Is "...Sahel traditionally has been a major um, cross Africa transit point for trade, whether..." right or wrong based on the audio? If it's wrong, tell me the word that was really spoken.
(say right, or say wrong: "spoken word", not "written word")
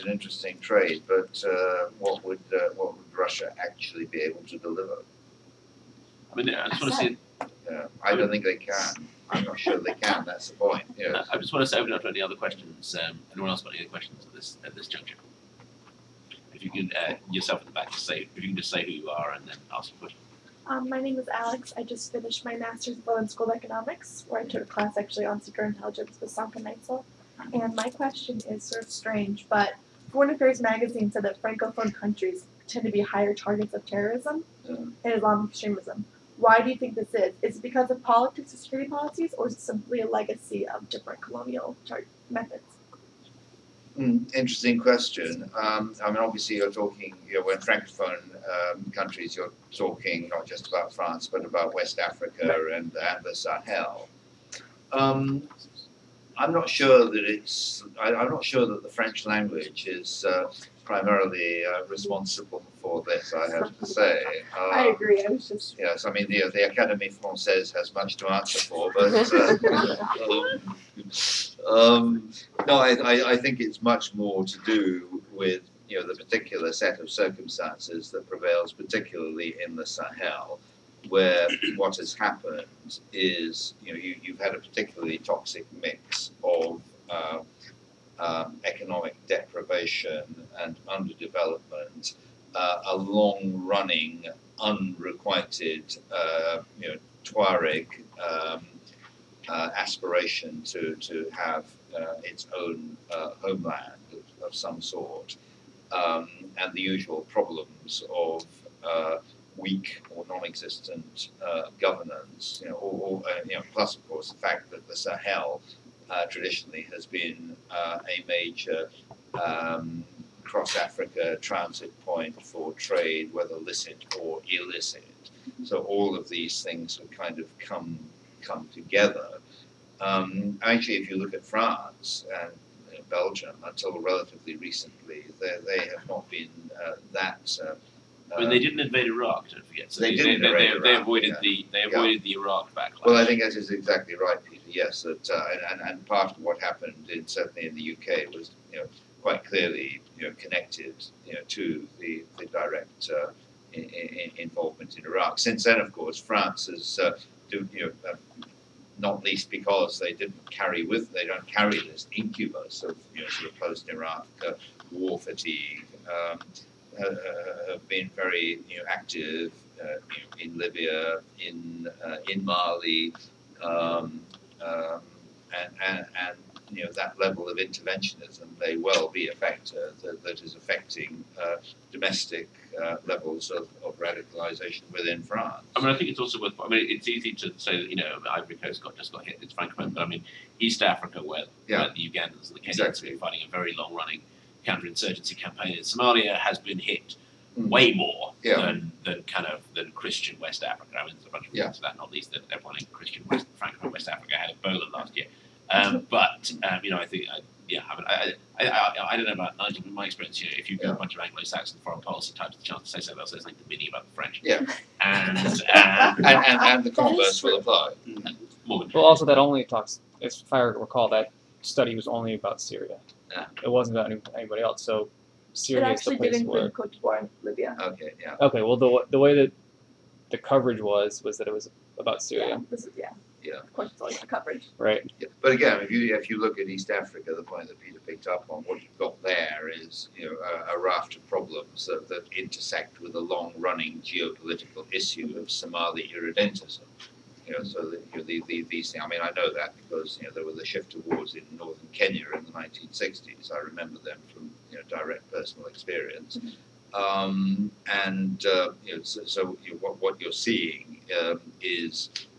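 right.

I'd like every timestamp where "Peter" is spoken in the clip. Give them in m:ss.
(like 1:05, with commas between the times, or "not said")
2:24, 3:57.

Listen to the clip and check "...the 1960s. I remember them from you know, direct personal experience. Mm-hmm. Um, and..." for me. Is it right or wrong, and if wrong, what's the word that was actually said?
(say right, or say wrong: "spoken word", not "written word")
right.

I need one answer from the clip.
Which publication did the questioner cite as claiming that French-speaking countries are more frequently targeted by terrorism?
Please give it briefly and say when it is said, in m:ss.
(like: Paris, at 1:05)
Foreign Affairs, at 0:30.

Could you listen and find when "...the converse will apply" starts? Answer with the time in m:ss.
3:36.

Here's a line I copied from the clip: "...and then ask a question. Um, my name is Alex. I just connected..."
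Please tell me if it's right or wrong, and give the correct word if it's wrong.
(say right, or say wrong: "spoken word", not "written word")
wrong: "finished", not "connected".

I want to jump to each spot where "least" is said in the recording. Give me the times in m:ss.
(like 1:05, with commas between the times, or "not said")
2:39, 3:22.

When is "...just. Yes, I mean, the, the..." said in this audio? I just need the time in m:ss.
1:05.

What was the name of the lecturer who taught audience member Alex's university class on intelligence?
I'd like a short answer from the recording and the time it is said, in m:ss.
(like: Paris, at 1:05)
Sönke Neitzel, at 0:26.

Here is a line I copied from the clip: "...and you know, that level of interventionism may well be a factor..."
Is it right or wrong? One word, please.
right.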